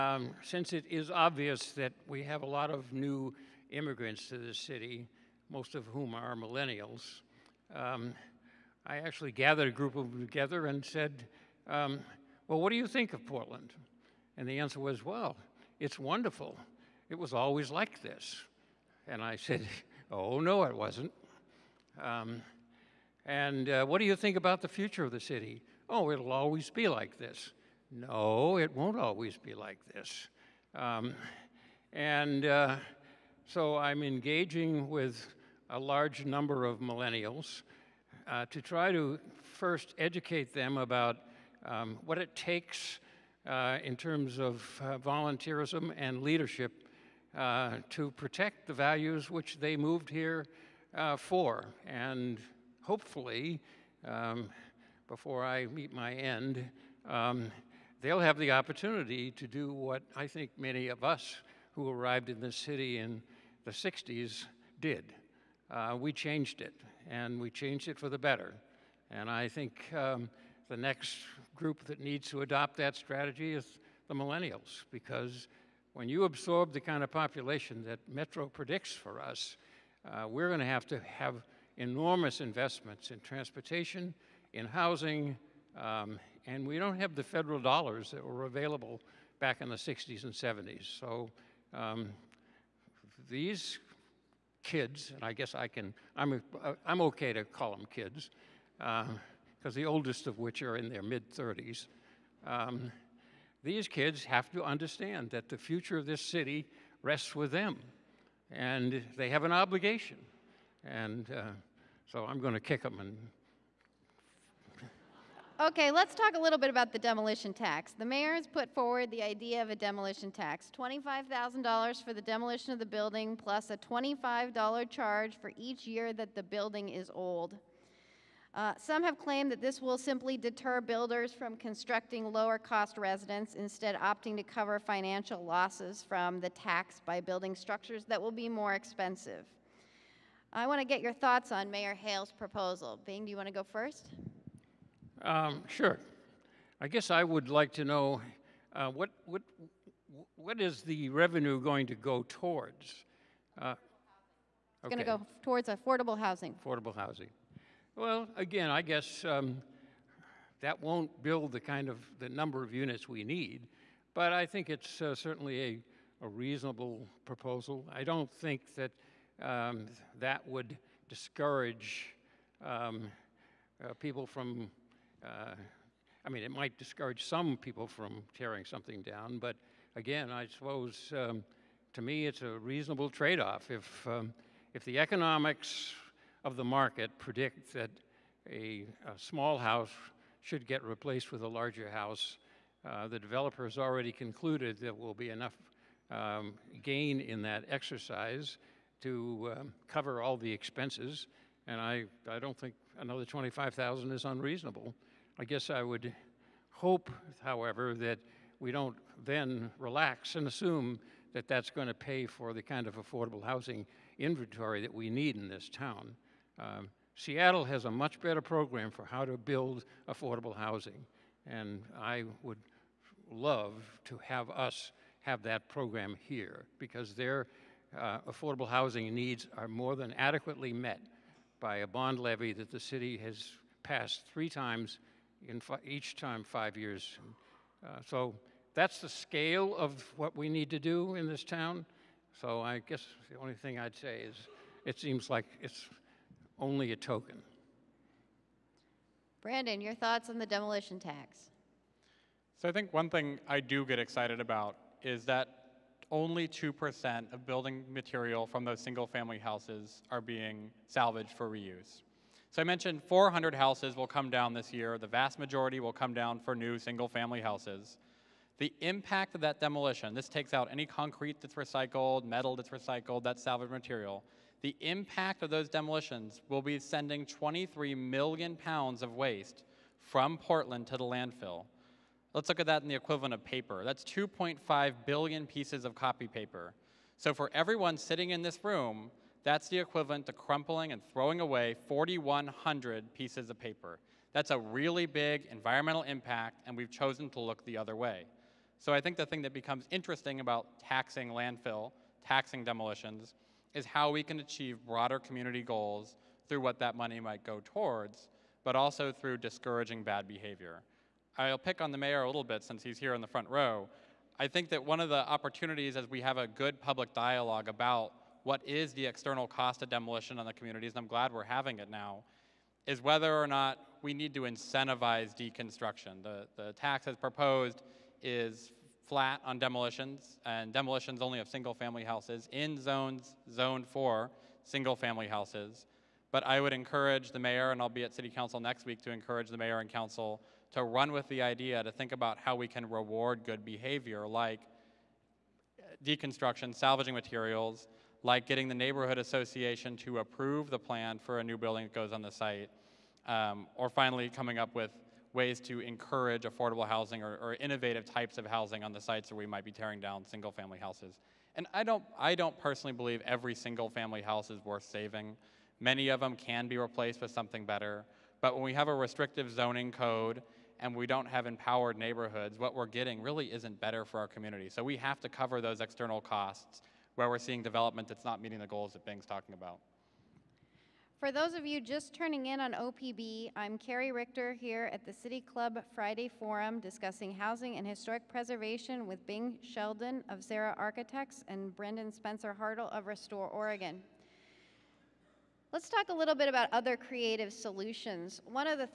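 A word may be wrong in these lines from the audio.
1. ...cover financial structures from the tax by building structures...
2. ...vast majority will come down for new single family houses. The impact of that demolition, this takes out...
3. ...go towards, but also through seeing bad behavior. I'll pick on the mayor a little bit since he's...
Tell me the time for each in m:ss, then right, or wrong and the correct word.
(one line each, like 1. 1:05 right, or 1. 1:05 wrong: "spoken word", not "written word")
1. 2:14 wrong: "losses", not "structures"
2. 4:25 right
3. 5:07 wrong: "discouraging", not "seeing".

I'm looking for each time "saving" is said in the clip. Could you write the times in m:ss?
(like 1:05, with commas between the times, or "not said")
6:04.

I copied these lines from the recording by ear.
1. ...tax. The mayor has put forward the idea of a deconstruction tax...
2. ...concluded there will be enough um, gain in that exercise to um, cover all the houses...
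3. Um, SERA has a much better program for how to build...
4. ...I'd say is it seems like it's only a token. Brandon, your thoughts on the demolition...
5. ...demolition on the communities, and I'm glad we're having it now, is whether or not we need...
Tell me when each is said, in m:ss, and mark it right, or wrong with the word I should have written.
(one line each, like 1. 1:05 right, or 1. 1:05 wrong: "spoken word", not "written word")
1. 1:57 wrong: "demolition", not "deconstruction"
2. 3:14 wrong: "expenses", not "houses"
3. 3:36 wrong: "Seattle", not "SERA"
4. 4:03 right
5. 5:19 right.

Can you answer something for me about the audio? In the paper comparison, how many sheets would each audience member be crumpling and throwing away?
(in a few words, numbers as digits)
4,100.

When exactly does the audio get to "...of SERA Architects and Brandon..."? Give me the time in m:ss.
6:30.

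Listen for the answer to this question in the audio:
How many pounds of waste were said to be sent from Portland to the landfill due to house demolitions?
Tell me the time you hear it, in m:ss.
4:37.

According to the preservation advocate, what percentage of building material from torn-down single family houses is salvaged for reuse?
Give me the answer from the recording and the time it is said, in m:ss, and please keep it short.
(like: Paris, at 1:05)
2%, at 4:16.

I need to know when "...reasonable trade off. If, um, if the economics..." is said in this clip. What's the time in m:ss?
3:02.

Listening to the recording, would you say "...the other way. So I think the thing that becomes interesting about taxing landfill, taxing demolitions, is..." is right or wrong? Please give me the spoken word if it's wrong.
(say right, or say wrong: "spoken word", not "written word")
right.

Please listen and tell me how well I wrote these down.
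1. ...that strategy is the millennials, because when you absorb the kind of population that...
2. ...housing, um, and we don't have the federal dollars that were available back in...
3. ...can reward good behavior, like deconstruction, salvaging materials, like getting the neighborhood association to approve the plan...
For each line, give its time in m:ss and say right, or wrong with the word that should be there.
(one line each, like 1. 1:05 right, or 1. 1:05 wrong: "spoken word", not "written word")
1. 1:12 right
2. 1:24 right
3. 5:42 right.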